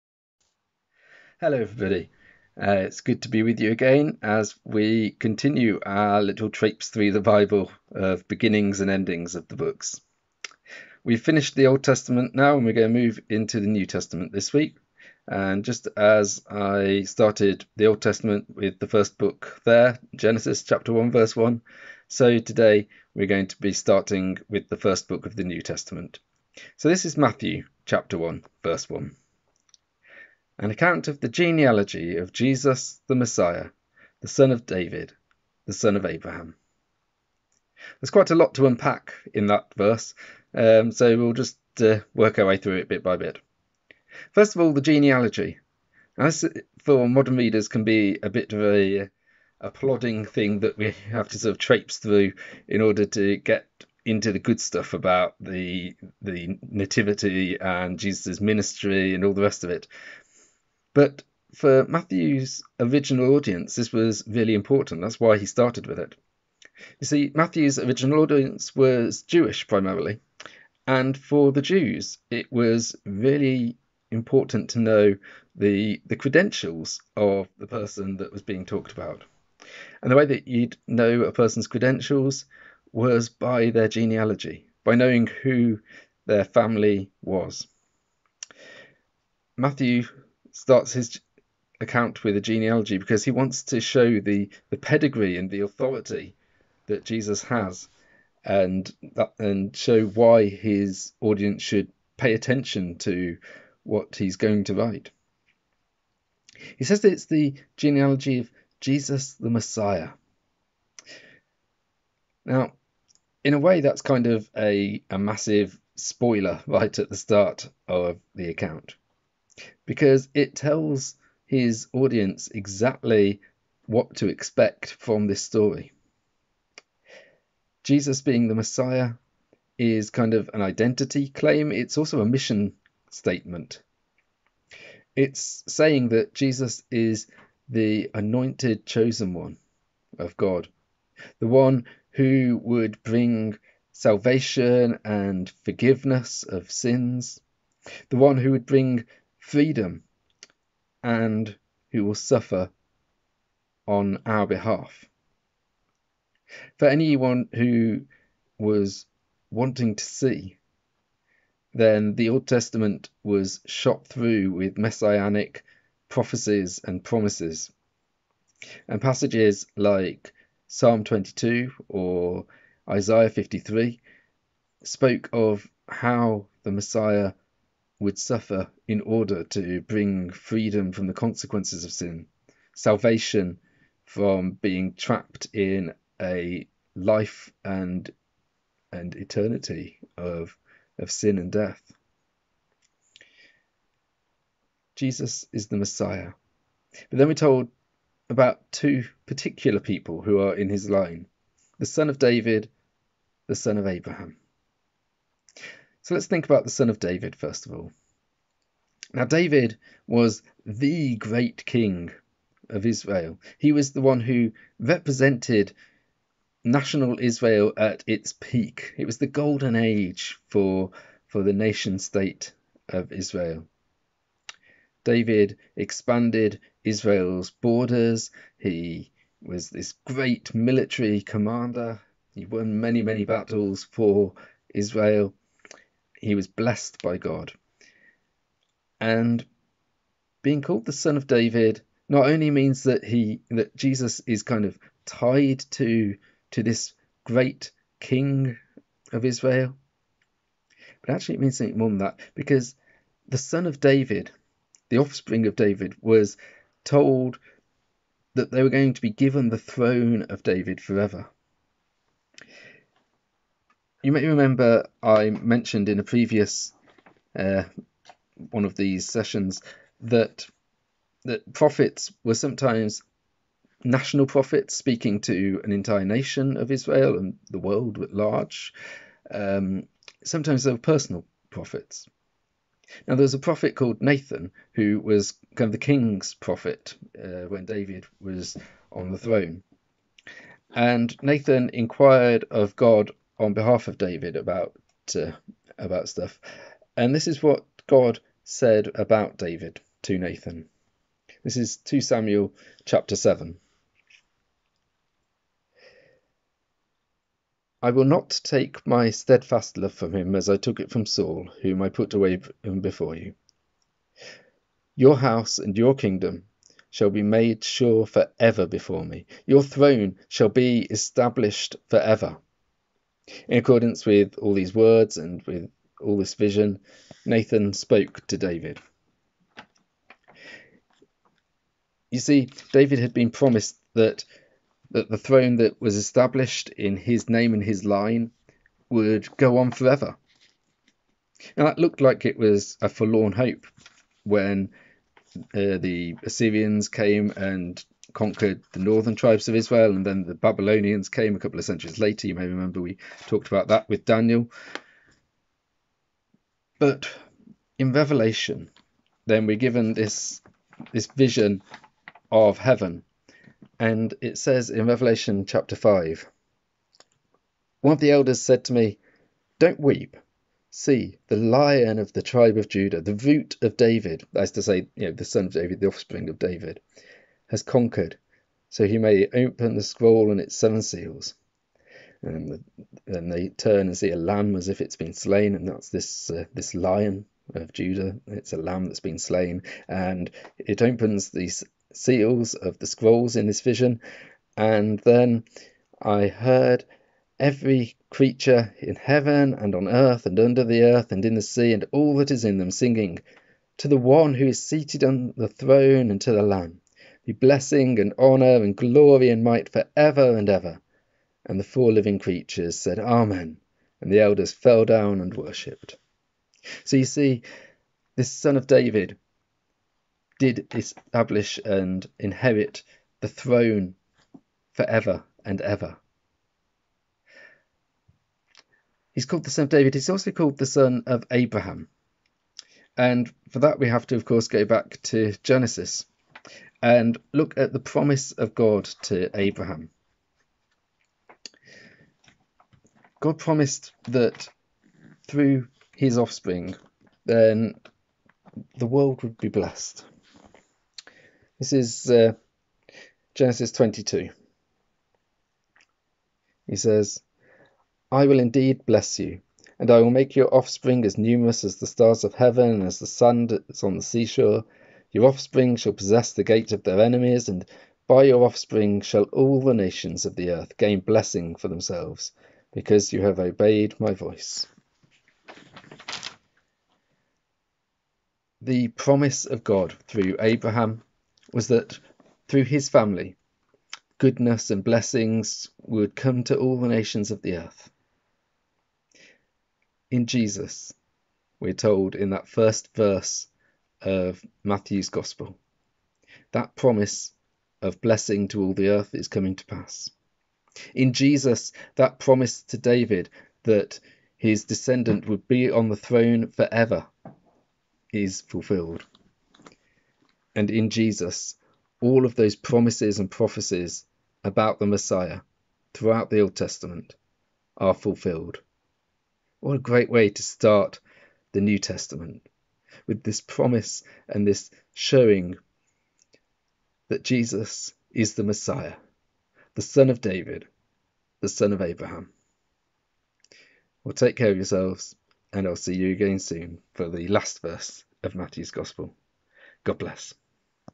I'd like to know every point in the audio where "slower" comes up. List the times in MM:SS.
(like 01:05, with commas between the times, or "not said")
not said.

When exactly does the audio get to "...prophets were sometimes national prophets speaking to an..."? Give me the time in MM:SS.
04:31.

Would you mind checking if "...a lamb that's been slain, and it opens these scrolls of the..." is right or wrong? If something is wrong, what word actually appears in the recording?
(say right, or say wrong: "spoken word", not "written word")
wrong: "seals", not "scrolls".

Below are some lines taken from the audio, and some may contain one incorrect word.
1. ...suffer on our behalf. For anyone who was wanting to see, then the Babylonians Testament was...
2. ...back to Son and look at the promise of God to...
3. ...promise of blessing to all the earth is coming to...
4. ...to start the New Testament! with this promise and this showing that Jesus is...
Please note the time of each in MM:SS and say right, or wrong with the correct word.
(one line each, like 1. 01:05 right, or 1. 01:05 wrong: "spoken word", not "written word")
1. 02:32 wrong: "Old", not "Babylonians"
2. 07:14 wrong: "Genesis", not "Son"
3. 08:16 right
4. 08:40 right.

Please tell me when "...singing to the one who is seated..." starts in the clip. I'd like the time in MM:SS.
06:42.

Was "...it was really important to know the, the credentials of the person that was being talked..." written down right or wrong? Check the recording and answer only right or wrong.
right.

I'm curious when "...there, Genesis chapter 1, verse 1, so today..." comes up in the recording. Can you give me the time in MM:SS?
00:19.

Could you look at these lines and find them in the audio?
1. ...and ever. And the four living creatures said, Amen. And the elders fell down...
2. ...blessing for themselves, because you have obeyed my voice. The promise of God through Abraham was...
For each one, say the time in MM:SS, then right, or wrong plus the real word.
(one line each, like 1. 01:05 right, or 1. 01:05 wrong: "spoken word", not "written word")
1. 06:50 right
2. 07:51 right.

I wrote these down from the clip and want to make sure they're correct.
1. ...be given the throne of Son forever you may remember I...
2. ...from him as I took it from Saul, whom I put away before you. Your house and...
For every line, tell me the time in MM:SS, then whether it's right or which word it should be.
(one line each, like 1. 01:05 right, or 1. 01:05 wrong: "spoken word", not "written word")
1. 04:19 wrong: "David", not "Son"
2. 05:09 right.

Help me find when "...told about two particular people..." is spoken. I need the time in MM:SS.
03:17.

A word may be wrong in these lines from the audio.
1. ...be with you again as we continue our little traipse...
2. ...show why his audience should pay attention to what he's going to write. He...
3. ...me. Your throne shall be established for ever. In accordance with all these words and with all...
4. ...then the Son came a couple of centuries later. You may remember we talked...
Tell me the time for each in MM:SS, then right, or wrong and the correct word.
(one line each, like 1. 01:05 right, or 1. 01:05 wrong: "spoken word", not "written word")
1. 00:03 right
2. 01:39 right
3. 05:19 right
4. 05:50 wrong: "Babylonians", not "Son".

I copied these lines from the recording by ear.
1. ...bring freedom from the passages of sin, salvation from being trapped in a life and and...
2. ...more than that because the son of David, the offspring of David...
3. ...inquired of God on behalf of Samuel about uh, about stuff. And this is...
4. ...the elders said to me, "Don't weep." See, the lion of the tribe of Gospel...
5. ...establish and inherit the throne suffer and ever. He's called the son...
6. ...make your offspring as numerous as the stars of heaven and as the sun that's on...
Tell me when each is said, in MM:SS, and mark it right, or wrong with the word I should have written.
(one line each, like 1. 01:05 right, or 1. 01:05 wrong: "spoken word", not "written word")
1. 02:59 wrong: "consequences", not "passages"
2. 04:11 right
3. 04:51 wrong: "David", not "Samuel"
4. 06:07 wrong: "Judah", not "Gospel"
5. 07:00 wrong: "forever", not "suffer"
6. 07:40 right.